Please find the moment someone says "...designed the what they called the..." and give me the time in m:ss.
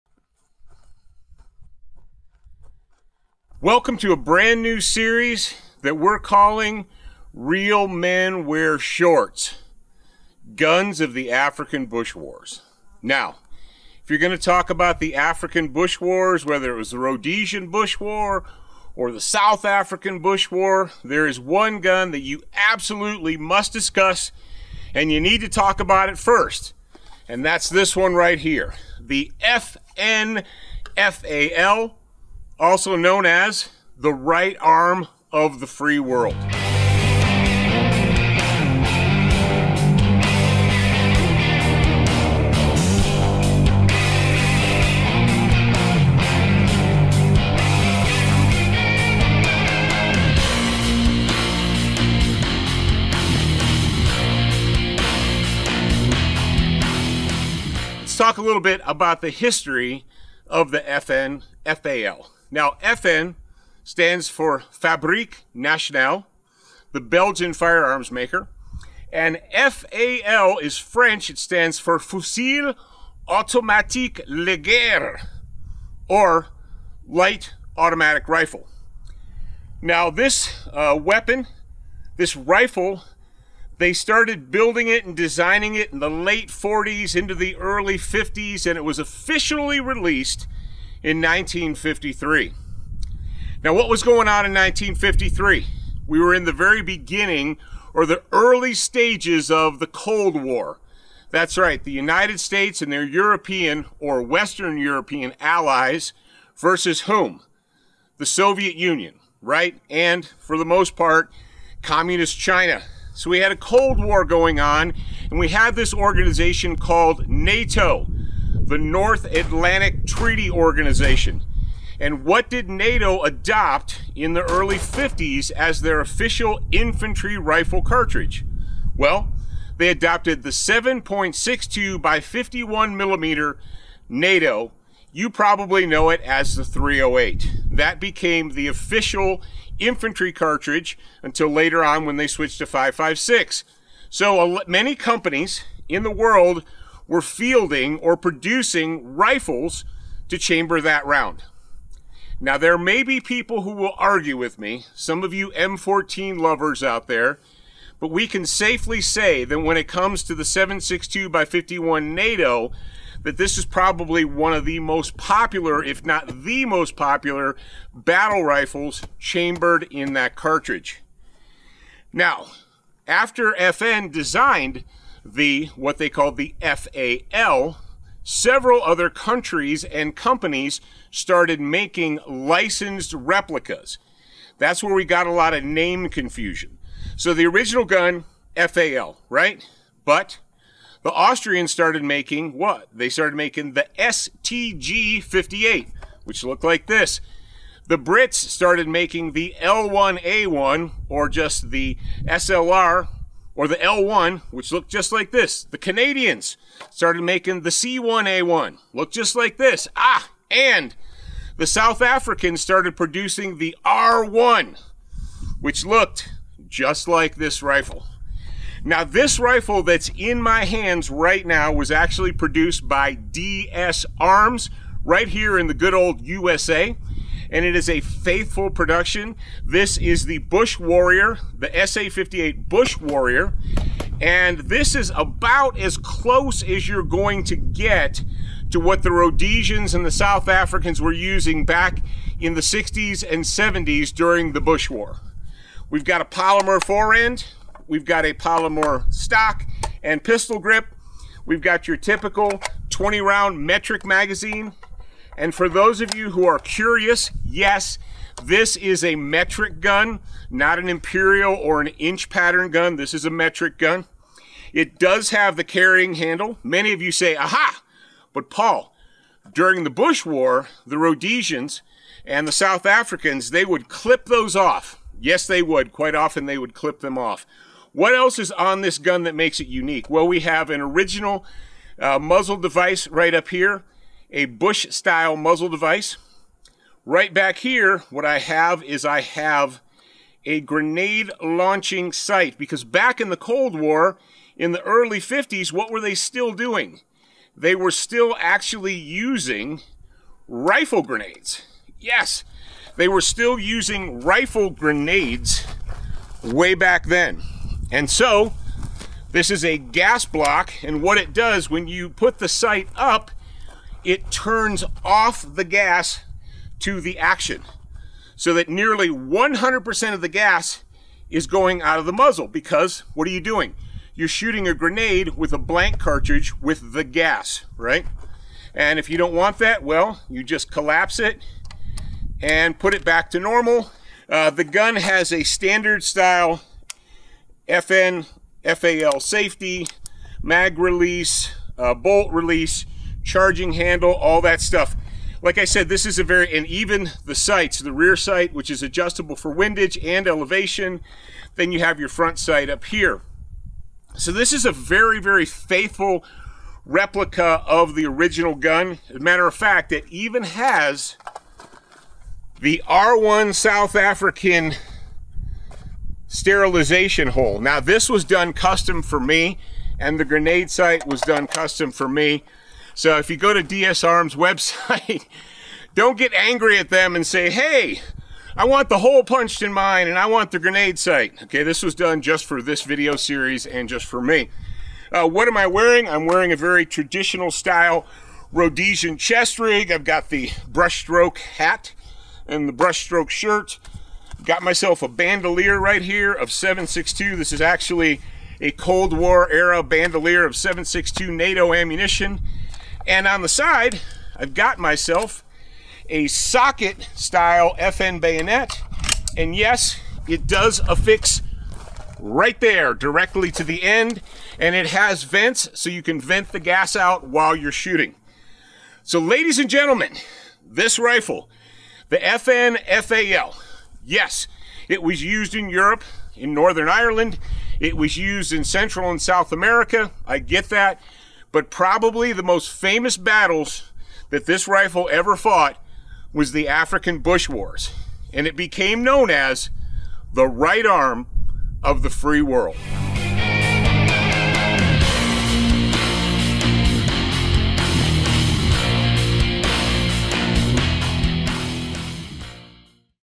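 2:54.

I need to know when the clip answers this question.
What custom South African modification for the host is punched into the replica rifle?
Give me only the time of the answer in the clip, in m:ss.
6:06.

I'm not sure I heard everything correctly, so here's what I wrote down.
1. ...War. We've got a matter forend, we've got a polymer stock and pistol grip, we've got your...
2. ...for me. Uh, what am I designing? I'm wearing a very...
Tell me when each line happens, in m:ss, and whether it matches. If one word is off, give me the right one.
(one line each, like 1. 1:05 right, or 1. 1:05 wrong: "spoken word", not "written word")
1. 4:04 wrong: "polymer", not "matter"
2. 6:24 wrong: "wearing", not "designing".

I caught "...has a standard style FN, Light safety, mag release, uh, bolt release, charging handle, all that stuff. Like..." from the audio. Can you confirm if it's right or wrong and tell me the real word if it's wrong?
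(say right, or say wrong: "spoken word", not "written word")
wrong: "FAL", not "Light".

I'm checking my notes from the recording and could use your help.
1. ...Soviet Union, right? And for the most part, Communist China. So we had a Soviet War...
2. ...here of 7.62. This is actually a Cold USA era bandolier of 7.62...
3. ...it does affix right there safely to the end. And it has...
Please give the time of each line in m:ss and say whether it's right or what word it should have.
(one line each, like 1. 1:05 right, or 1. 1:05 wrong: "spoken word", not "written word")
1. 1:48 wrong: "Cold", not "Soviet"
2. 6:36 wrong: "War", not "USA"
3. 6:50 wrong: "directly", not "safely".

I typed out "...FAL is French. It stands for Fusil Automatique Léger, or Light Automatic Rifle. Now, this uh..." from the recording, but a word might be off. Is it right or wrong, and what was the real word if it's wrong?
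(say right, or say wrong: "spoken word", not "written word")
right.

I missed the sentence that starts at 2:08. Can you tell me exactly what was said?
Well, they adopted the 7.62 by 51 millimeter NATO.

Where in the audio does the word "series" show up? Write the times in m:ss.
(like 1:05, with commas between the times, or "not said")
0:04, 6:23.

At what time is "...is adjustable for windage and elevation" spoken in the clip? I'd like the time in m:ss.
5:48.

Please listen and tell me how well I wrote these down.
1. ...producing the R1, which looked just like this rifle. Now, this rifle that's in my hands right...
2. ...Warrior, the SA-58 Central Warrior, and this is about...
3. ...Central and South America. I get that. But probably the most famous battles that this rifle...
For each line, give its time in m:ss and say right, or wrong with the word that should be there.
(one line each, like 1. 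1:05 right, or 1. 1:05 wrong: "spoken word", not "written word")
1. 3:32 right
2. 3:50 wrong: "Bush", not "Central"
3. 7:08 right.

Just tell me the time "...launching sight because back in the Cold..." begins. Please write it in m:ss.
4:51.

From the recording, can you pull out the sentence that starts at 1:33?
Now, what was going on in 1953?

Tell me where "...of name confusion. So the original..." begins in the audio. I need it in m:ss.
3:05.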